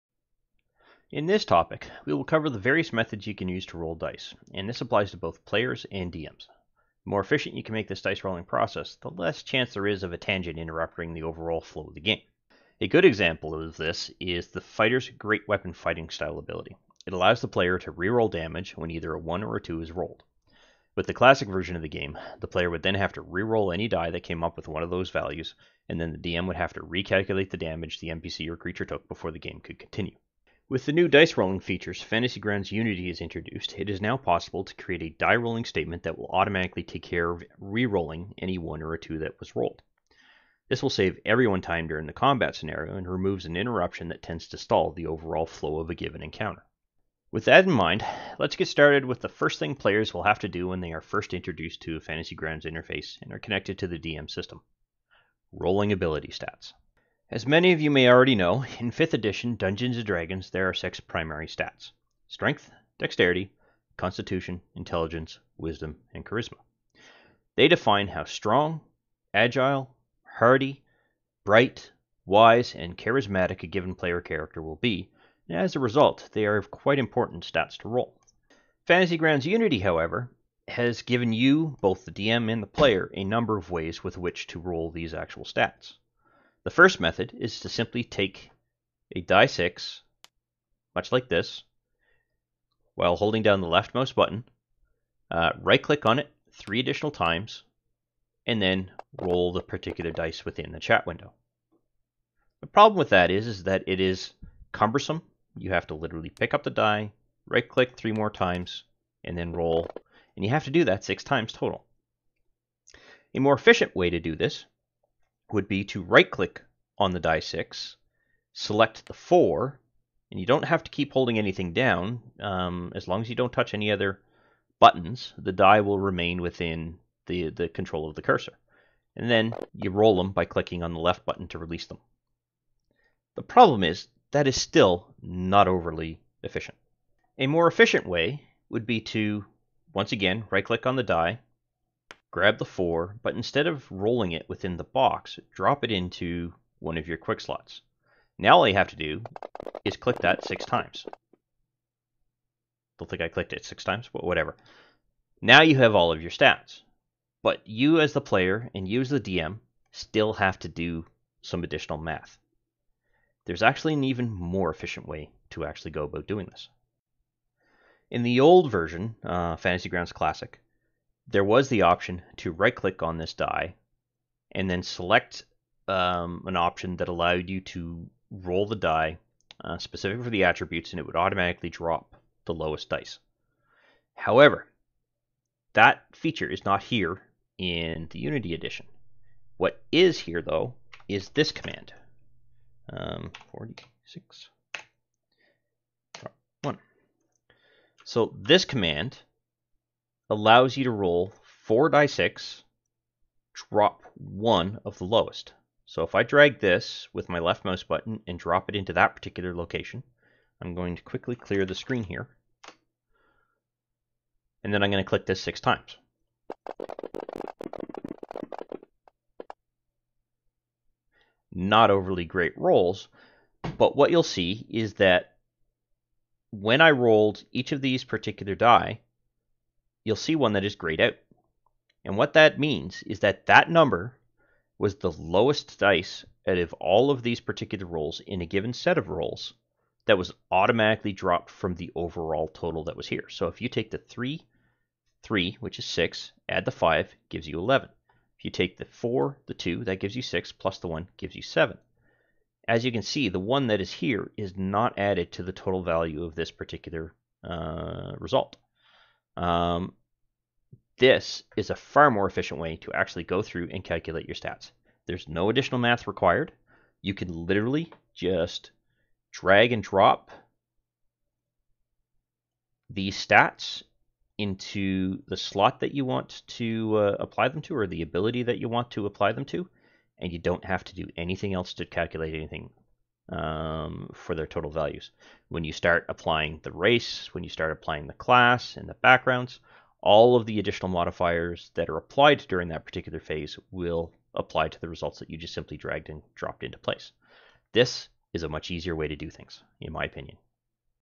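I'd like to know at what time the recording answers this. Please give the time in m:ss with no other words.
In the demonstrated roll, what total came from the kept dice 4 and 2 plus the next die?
4:11.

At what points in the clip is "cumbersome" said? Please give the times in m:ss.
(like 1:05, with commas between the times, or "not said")
1:44.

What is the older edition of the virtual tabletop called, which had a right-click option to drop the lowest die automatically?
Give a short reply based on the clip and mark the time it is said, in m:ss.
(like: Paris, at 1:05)
Fantasy Grounds Classic, at 2:49.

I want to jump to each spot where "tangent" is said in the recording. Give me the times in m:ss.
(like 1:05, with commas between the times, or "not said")
0:10.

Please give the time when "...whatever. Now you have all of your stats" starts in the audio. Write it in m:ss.
2:34.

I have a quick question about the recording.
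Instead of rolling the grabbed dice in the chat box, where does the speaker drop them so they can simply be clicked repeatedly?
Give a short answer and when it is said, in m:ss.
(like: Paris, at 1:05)
quick slots, at 2:27.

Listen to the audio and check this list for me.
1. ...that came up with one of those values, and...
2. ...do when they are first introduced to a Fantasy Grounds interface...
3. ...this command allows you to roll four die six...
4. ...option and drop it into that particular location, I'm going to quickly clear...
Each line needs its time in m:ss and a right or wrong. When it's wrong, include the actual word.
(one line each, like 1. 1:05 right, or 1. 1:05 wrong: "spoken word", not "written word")
1. 0:24 right
2. 0:50 right
3. 3:18 right
4. 3:27 wrong: "button", not "option".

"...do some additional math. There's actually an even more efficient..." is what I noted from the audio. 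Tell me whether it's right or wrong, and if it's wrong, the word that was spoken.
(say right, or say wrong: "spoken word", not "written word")
right.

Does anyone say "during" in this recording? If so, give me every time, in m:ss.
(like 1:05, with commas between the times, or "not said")
0:41, 4:52.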